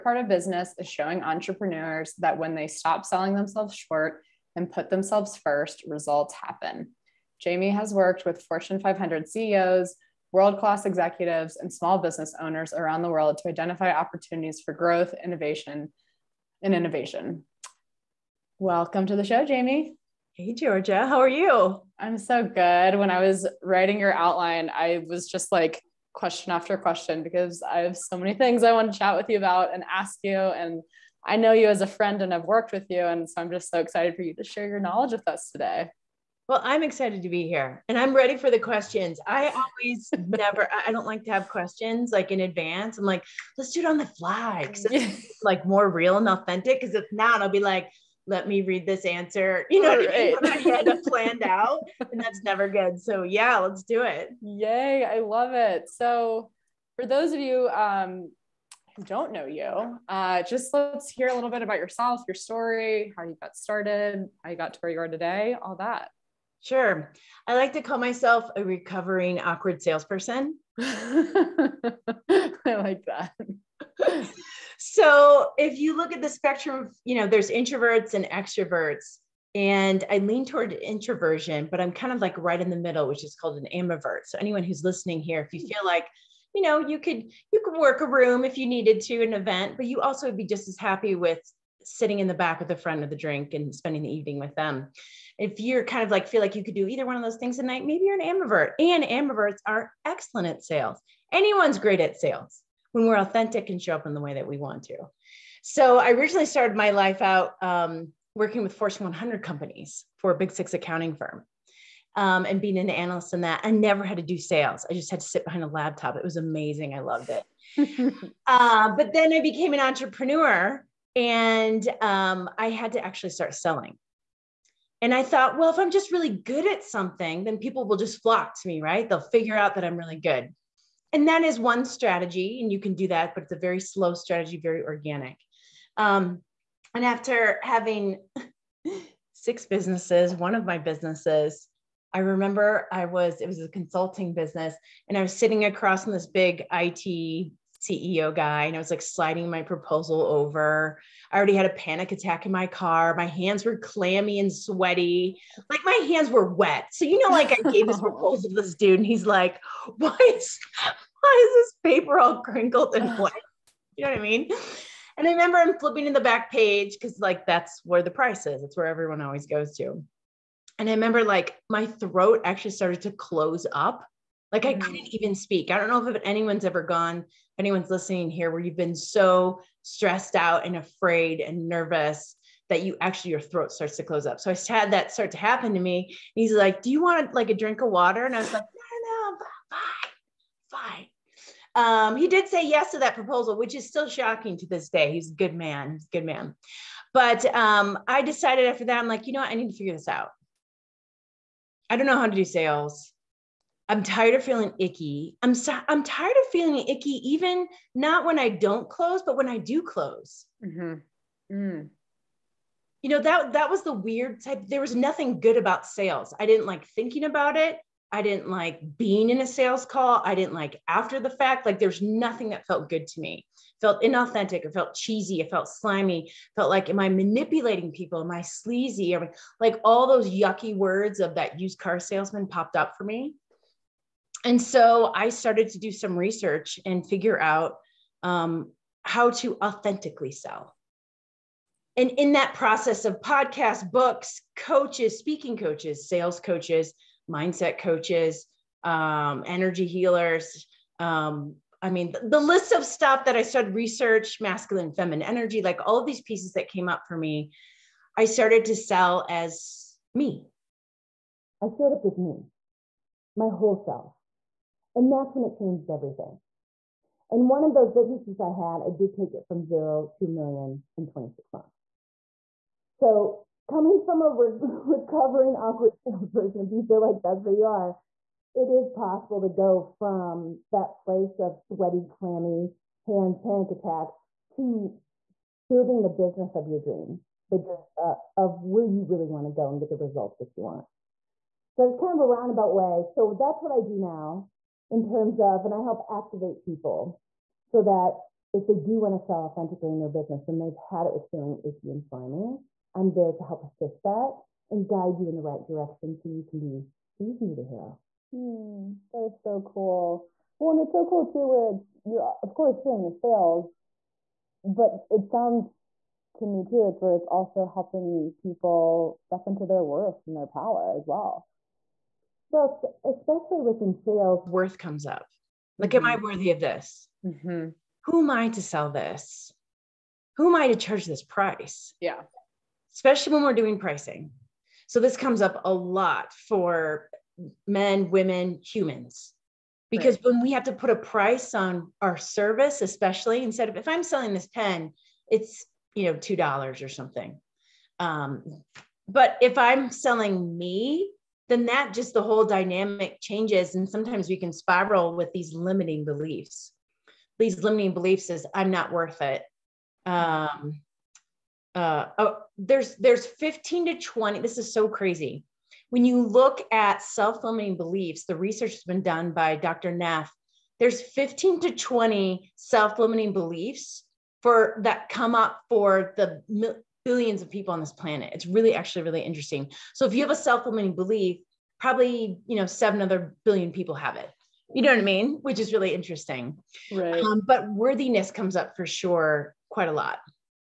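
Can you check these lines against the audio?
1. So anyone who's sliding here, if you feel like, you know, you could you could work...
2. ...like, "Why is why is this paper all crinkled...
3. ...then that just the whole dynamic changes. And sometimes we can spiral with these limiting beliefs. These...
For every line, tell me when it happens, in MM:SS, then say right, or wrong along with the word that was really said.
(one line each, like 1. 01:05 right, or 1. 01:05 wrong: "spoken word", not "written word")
1. 01:24 wrong: "listening", not "sliding"
2. 02:39 right
3. 05:51 right.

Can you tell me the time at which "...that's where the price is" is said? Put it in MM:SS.
02:47.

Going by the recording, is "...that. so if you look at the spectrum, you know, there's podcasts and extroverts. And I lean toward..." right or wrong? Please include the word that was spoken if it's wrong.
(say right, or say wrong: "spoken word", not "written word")
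wrong: "introverts", not "podcasts".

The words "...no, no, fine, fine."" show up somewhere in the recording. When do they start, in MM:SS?
03:09.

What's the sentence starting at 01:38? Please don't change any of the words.
And ambiverts are excellent at sales.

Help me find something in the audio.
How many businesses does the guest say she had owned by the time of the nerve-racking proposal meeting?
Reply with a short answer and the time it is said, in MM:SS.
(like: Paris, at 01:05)
6, at 02:19.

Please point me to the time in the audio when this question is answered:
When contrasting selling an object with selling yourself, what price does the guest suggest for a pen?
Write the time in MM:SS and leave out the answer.
05:46.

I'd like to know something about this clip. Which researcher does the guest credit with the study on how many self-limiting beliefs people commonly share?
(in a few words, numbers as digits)
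Dr. Neff.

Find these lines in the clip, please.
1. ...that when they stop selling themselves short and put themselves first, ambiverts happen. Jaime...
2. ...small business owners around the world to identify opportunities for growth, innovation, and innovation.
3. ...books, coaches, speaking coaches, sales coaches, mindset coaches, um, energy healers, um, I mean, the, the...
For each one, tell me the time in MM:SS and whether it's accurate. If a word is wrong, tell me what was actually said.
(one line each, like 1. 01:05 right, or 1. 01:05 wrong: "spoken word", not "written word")
1. 00:02 wrong: "results", not "ambiverts"
2. 00:11 right
3. 04:03 right.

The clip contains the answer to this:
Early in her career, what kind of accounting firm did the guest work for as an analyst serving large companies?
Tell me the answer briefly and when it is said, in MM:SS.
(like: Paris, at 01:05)
Big Six accounting firm, at 01:50.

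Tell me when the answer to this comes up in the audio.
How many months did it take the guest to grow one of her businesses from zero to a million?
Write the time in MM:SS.
04:31.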